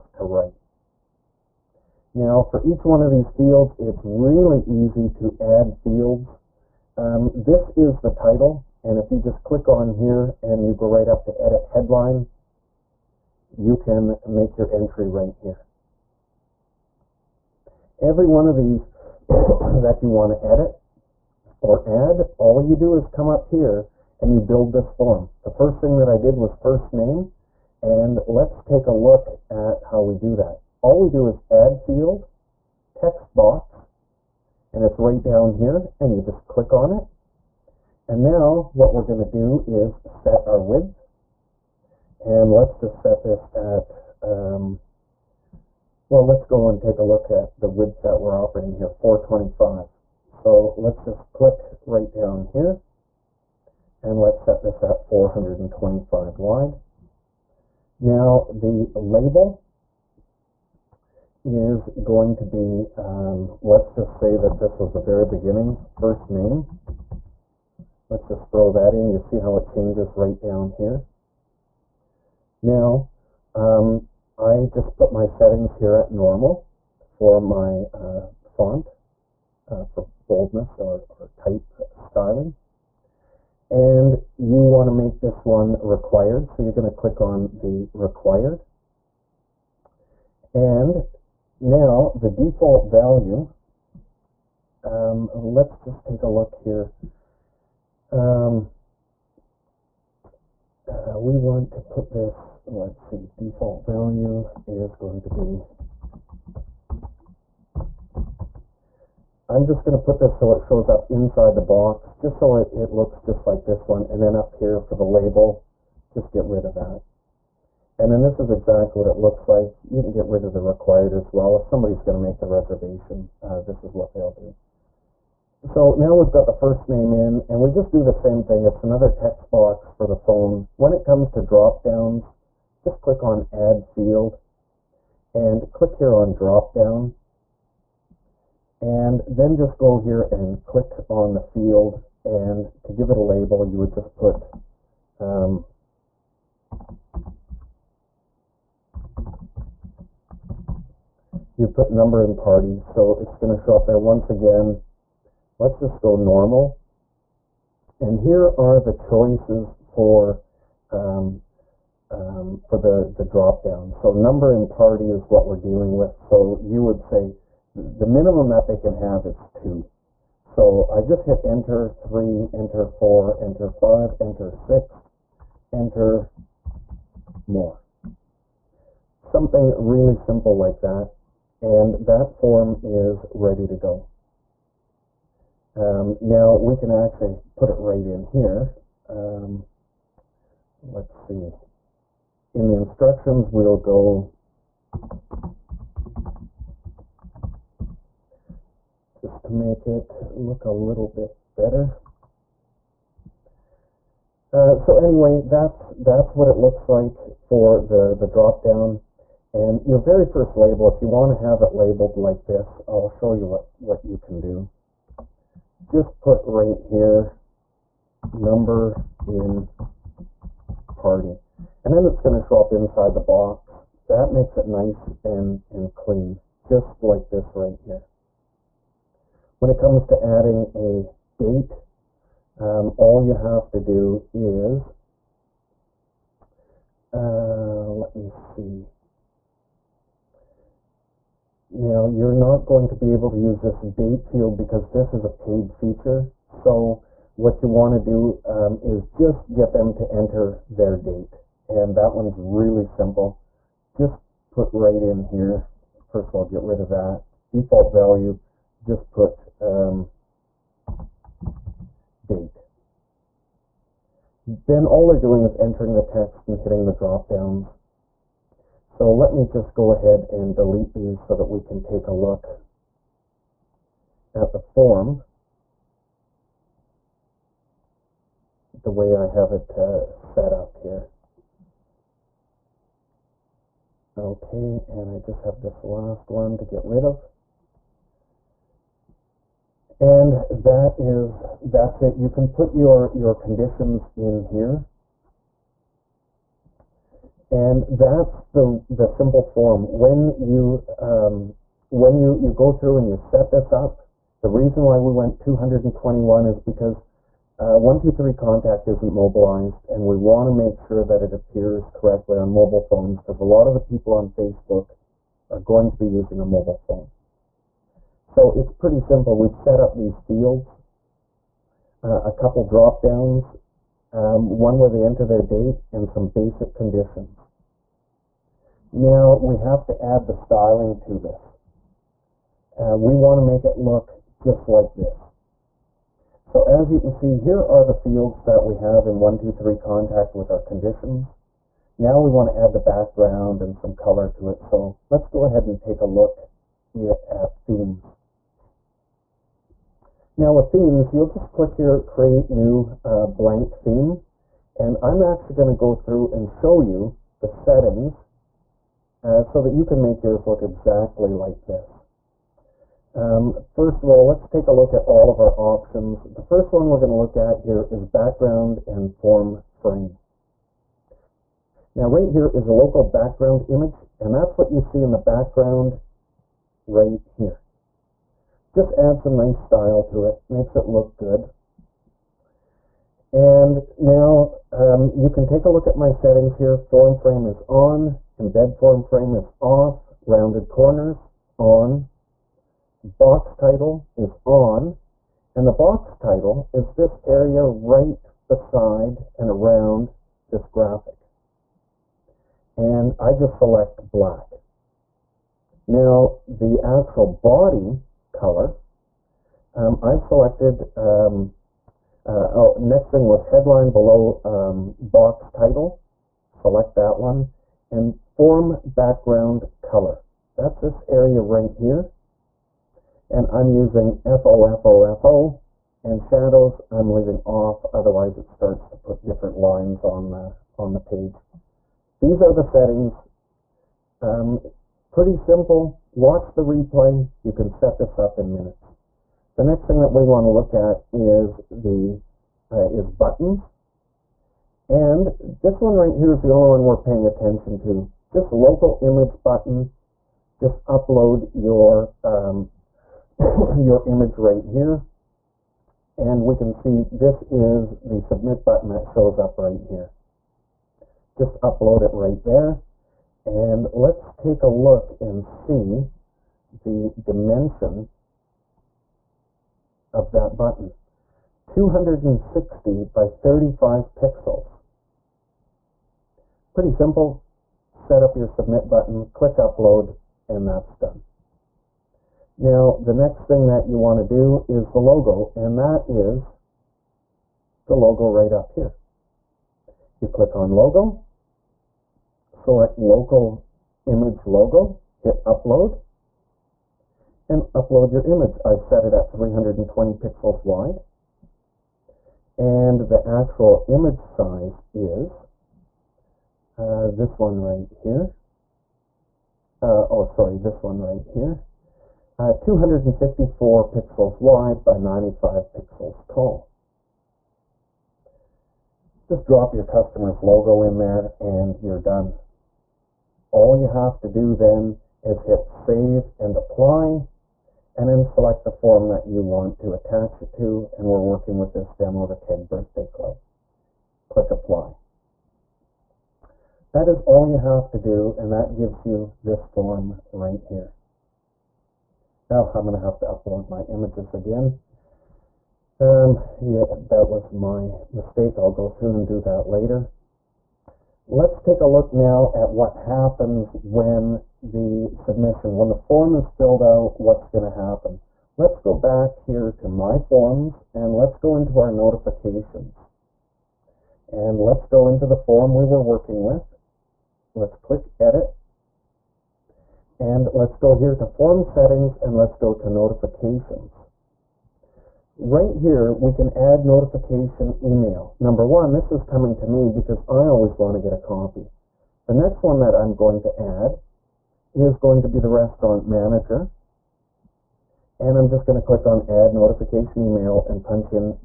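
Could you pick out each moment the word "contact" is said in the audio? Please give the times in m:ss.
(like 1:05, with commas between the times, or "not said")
5:08, 5:39.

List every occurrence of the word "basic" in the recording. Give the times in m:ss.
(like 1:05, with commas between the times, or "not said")
5:26.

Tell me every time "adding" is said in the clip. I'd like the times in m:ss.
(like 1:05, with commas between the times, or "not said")
3:50.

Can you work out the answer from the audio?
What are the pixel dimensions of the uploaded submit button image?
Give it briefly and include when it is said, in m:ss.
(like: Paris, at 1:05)
260 by 35, at 7:51.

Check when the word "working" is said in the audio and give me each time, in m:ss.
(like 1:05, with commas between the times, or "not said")
8:51, 9:26.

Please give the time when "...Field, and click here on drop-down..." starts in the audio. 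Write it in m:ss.
2:13.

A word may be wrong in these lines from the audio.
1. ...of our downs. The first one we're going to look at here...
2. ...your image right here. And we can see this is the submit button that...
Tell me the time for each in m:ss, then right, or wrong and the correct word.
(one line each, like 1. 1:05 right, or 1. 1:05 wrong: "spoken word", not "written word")
1. 6:05 wrong: "options", not "downs"
2. 7:33 right.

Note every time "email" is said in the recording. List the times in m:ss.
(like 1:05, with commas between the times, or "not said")
9:37, 9:50.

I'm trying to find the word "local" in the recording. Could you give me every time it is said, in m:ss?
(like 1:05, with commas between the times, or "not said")
6:12, 7:28, 8:12.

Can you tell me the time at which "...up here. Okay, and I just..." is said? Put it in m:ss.
4:40.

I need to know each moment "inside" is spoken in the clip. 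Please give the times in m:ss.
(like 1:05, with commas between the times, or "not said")
1:51, 3:42.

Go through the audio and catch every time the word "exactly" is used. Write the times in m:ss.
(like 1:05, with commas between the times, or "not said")
1:58, 6:00.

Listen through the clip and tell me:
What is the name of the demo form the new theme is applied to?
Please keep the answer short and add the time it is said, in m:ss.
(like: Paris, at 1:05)
Keg Birthday Club, at 8:52.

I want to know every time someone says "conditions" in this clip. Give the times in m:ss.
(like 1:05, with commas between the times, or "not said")
4:53, 5:26, 5:40.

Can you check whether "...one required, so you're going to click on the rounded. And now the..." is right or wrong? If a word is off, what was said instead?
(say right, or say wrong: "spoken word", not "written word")
wrong: "required", not "rounded".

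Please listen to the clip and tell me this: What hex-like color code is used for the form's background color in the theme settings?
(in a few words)
F0F0F0.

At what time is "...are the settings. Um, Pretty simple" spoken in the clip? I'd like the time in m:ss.
7:12.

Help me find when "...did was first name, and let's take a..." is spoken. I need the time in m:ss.
0:26.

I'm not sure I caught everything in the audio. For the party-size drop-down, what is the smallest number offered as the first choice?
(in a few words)
2.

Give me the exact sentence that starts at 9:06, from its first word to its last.
Um, yeah, that was my mistake.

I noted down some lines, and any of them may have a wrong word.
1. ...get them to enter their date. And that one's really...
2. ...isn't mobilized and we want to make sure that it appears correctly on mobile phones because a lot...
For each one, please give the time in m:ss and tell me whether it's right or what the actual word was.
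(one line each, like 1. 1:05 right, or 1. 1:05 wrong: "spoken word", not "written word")
1. 4:09 right
2. 5:08 right.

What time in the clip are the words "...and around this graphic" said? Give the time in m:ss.
6:39.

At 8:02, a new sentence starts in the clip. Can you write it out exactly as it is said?
Now the next thing that you want to do is the logo, and that is the logo right up here.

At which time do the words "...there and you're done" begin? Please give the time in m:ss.
8:40.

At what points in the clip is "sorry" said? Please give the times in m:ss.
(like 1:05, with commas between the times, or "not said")
8:30.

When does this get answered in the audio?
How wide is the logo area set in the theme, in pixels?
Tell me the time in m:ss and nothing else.
8:19.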